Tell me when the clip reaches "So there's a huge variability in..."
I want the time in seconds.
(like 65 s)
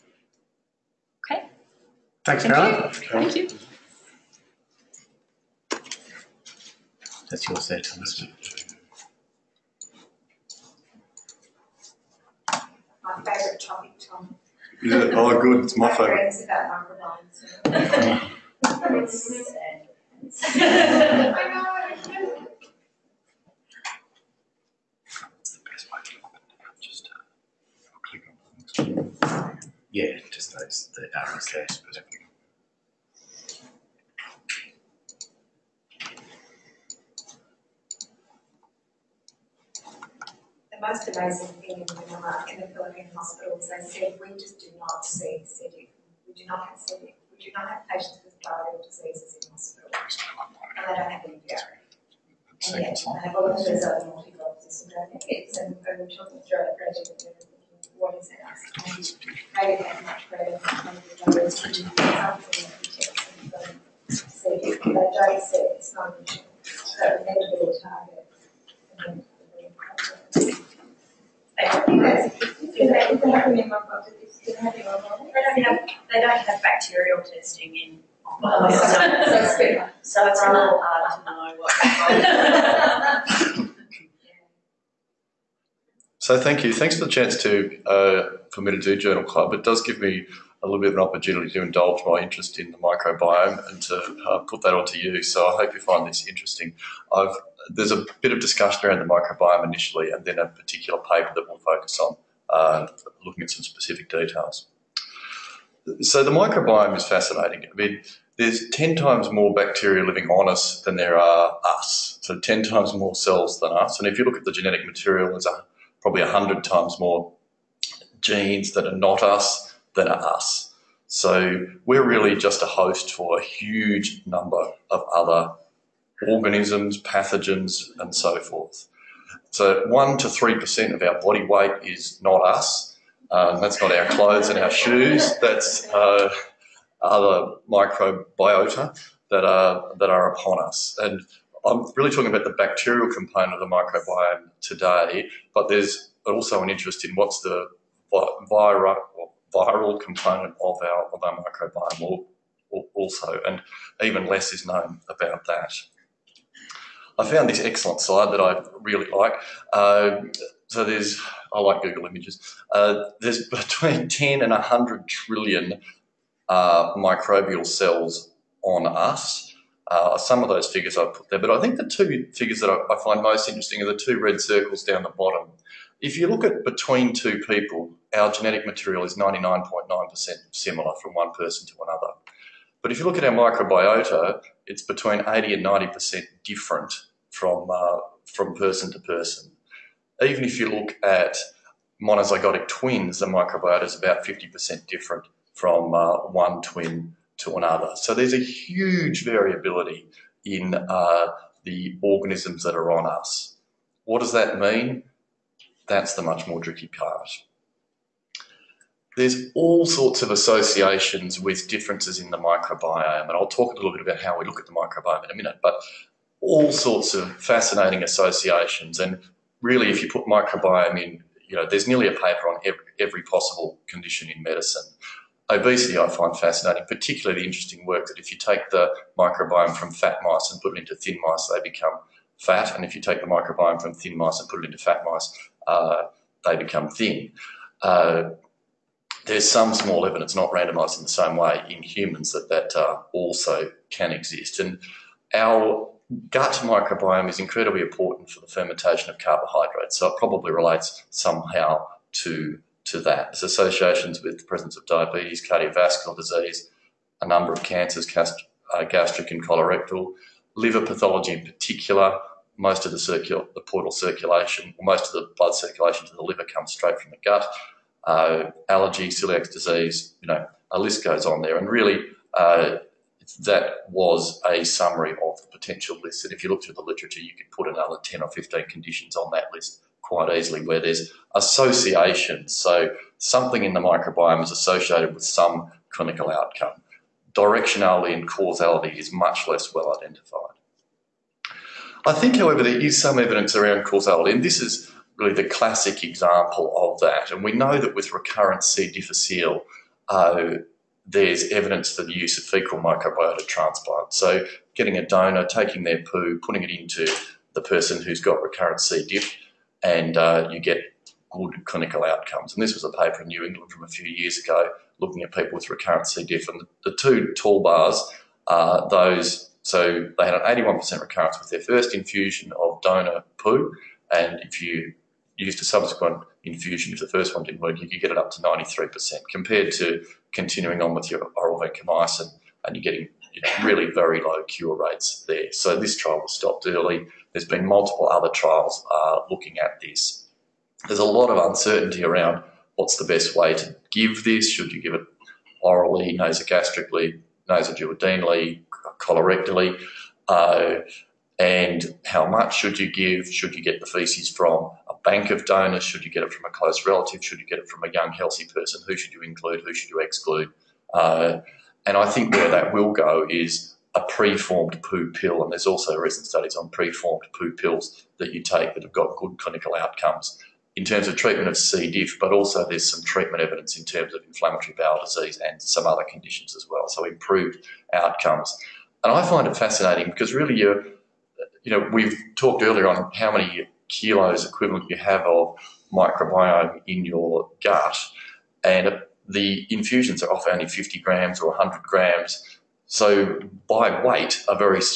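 197 s.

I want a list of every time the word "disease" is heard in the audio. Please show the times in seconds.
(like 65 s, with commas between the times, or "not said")
48 s, 256 s, 269 s, 375 s.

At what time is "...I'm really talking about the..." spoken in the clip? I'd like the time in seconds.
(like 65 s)
141 s.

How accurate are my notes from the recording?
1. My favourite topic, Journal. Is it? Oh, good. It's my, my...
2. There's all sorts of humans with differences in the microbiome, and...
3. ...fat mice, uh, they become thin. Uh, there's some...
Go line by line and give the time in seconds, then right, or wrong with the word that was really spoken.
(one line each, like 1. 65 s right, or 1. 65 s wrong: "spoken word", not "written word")
1. 13 s wrong: "Tom", not "Journal"
2. 209 s wrong: "associations", not "humans"
3. 234 s right.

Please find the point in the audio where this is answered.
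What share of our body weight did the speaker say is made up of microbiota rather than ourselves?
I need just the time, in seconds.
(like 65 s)
129 s.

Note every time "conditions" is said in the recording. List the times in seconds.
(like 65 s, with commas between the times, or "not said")
223 s, 278 s, 376 s.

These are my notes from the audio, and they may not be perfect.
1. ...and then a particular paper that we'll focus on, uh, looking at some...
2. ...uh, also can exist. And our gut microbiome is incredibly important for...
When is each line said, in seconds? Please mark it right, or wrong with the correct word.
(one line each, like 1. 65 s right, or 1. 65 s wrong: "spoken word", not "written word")
1. 100 s right
2. 242 s right.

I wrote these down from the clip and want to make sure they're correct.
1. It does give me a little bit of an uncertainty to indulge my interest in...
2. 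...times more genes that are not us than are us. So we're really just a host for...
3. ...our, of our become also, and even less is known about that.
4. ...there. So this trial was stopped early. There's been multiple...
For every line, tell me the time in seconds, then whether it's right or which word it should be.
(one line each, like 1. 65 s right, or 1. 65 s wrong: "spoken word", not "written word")
1. 89 s wrong: "opportunity", not "uncertainty"
2. 116 s right
3. 150 s wrong: "microbiome", not "become"
4. 335 s right.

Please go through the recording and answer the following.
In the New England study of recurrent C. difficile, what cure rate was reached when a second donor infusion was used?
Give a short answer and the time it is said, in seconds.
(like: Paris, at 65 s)
93%, at 328 s.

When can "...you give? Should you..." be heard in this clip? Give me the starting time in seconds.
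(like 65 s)
352 s.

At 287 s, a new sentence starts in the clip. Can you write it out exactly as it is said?
Directionality and causality is much less well identified.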